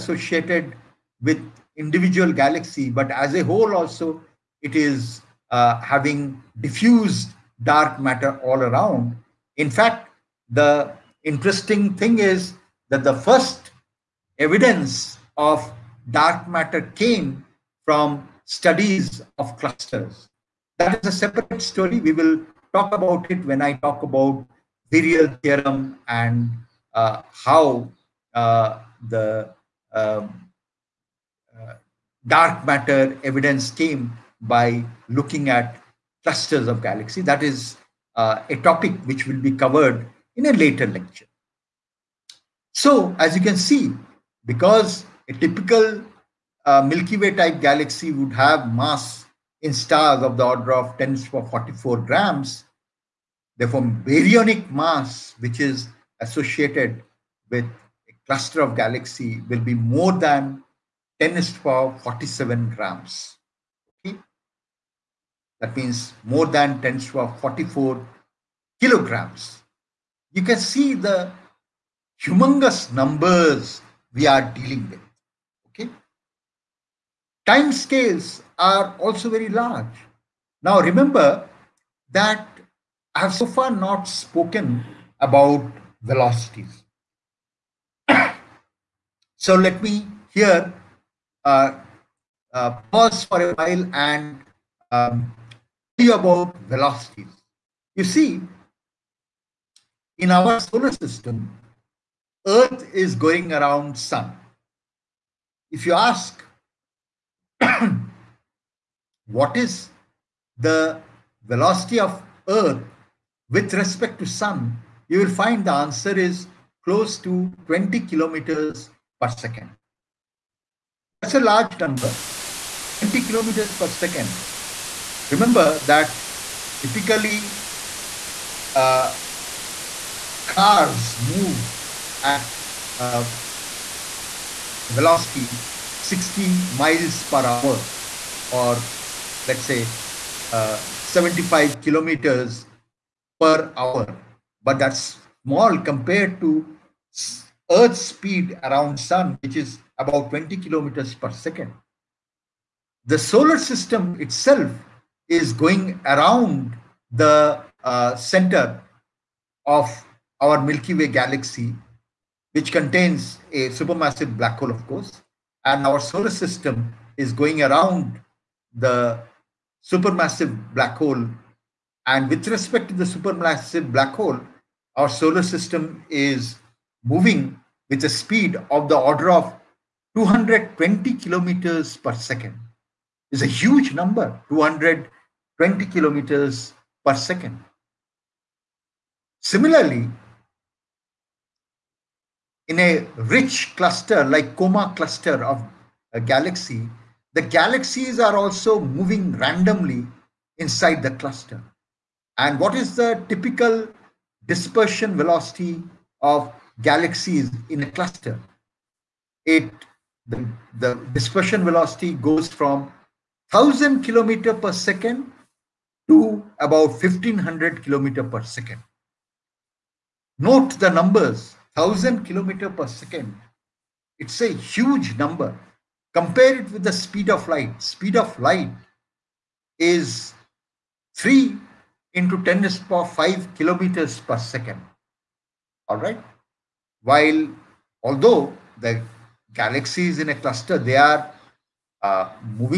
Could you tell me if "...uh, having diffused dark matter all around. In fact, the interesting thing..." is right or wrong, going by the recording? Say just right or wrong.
right.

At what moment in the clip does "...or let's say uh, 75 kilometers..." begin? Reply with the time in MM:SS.
02:18.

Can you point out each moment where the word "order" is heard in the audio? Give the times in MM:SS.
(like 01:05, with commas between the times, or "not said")
00:50, 02:58.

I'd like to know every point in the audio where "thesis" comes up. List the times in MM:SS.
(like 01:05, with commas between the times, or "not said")
not said.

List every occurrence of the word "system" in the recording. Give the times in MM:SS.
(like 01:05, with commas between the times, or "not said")
01:40, 02:33, 02:46, 02:55.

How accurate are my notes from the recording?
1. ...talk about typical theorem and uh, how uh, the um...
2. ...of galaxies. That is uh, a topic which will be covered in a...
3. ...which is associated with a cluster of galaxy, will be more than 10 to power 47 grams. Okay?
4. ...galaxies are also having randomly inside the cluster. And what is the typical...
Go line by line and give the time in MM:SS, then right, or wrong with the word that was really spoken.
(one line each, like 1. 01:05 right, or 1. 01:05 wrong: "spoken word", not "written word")
1. 00:23 wrong: "virial", not "typical"
2. 00:36 right
3. 00:55 right
4. 03:17 wrong: "moving", not "having".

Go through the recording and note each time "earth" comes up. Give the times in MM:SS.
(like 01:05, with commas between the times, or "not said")
01:42, 01:52, 02:27.